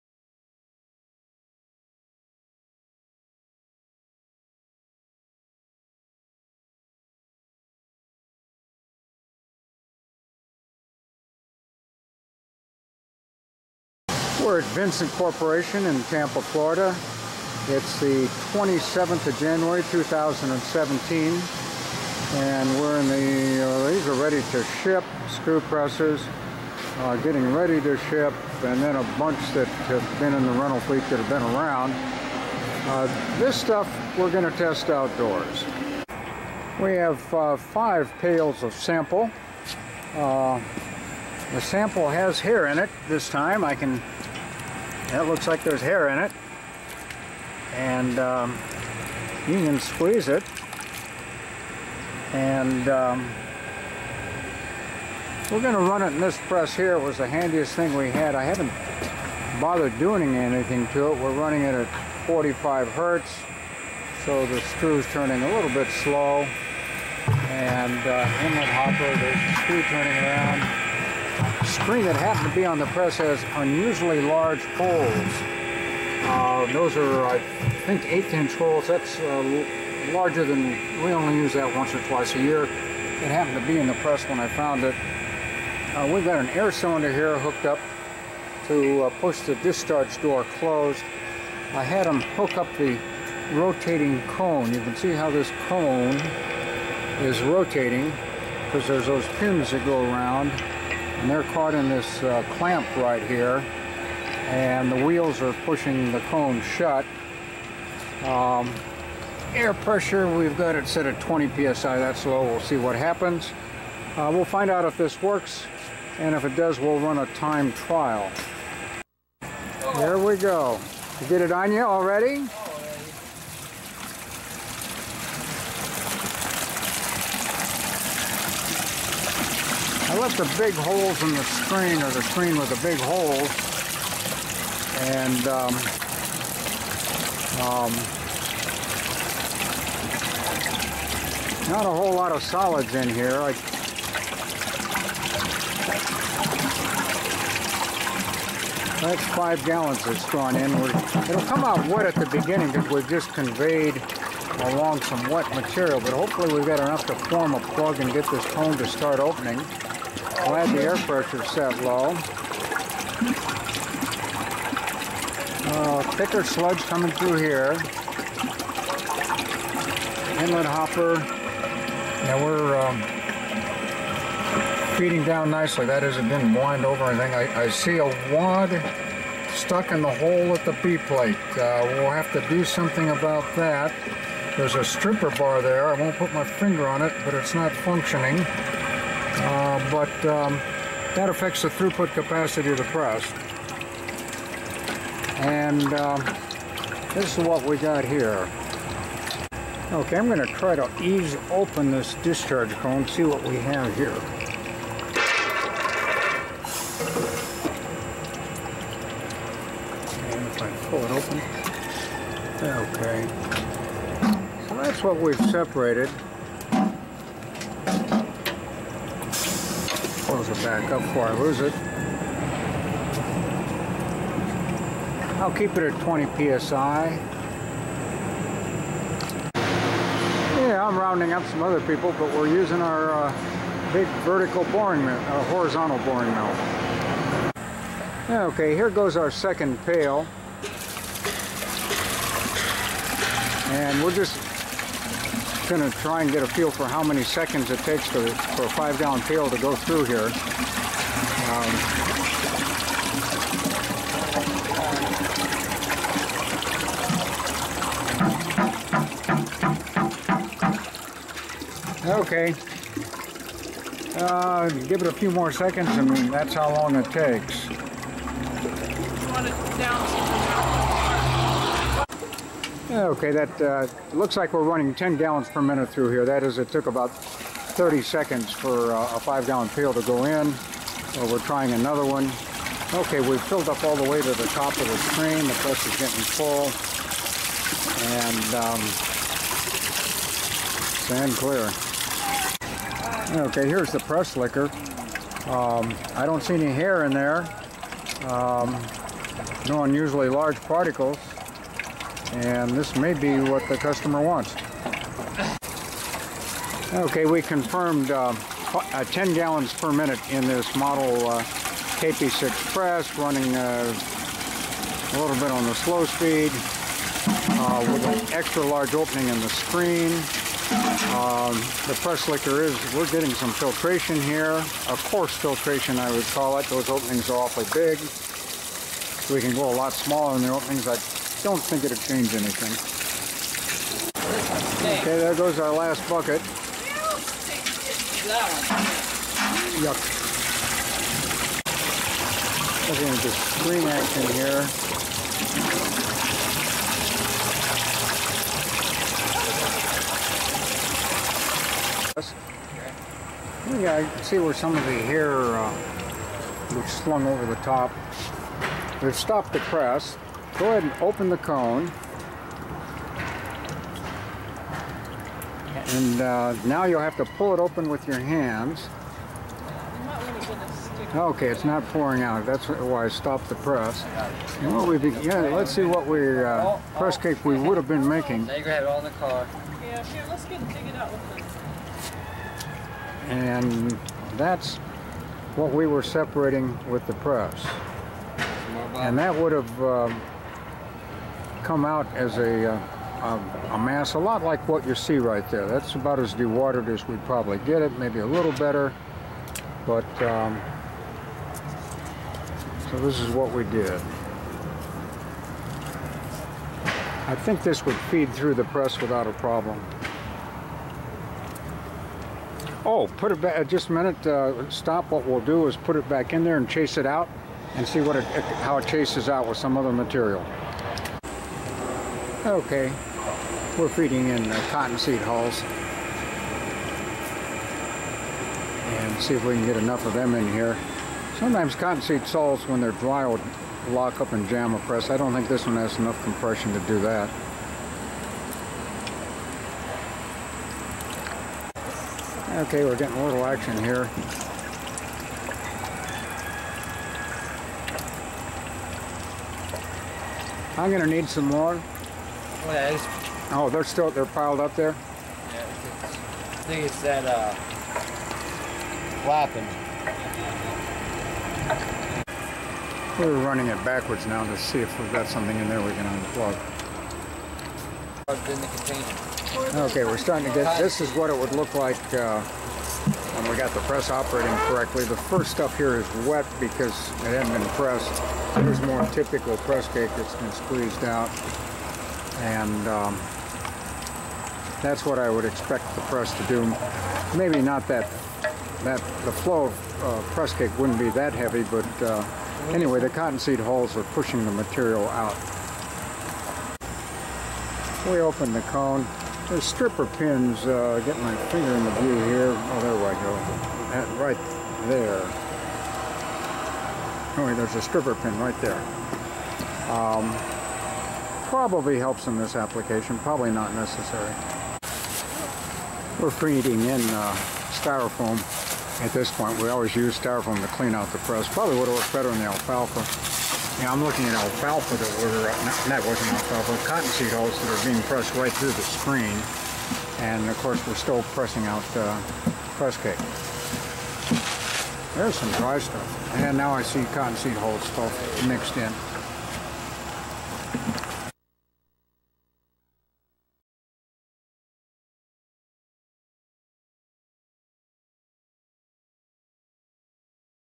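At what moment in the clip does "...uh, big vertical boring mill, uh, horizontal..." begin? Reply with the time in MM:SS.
03:53.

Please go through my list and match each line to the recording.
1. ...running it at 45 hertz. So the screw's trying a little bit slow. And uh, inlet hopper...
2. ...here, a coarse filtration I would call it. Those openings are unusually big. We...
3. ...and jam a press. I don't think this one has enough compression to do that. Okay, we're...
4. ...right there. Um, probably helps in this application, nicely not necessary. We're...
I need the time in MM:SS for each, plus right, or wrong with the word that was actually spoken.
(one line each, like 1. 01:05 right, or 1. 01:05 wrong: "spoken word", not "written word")
1. 01:01 wrong: "turning", not "trying"
2. 05:24 wrong: "awfully", not "unusually"
3. 07:14 right
4. 08:28 wrong: "probably", not "nicely".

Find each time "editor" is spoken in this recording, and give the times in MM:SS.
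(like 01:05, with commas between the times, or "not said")
not said.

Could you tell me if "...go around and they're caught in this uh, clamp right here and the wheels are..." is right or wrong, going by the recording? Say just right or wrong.
right.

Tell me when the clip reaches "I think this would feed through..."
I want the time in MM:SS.
06:47.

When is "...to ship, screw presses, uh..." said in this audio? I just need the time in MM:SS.
00:24.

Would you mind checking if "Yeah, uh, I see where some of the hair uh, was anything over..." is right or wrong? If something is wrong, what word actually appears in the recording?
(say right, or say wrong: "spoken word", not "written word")
wrong: "slung", not "anything".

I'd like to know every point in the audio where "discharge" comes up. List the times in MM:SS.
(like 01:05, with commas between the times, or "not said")
01:29, 03:22.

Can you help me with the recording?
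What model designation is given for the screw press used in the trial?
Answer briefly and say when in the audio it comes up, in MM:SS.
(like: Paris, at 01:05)
KP6, at 05:12.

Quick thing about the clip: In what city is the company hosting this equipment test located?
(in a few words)
Tampa.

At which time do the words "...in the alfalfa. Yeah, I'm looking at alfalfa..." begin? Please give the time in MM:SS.
08:42.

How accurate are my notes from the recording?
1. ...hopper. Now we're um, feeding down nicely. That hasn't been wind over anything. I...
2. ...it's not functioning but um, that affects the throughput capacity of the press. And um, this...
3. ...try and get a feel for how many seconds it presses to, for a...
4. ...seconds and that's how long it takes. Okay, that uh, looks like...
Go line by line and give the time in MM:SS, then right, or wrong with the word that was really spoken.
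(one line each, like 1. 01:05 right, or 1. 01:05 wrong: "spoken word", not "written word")
1. 02:50 right
2. 03:07 right
3. 04:05 wrong: "takes", not "presses"
4. 04:25 right.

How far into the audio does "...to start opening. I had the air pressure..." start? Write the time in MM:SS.
02:38.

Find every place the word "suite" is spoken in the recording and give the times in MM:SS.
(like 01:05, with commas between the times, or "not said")
not said.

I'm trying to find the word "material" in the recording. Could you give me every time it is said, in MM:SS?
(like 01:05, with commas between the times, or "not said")
02:35, 06:59, 08:14.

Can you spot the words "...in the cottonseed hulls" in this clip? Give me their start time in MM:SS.
07:04.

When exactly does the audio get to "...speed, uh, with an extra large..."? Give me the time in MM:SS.
05:16.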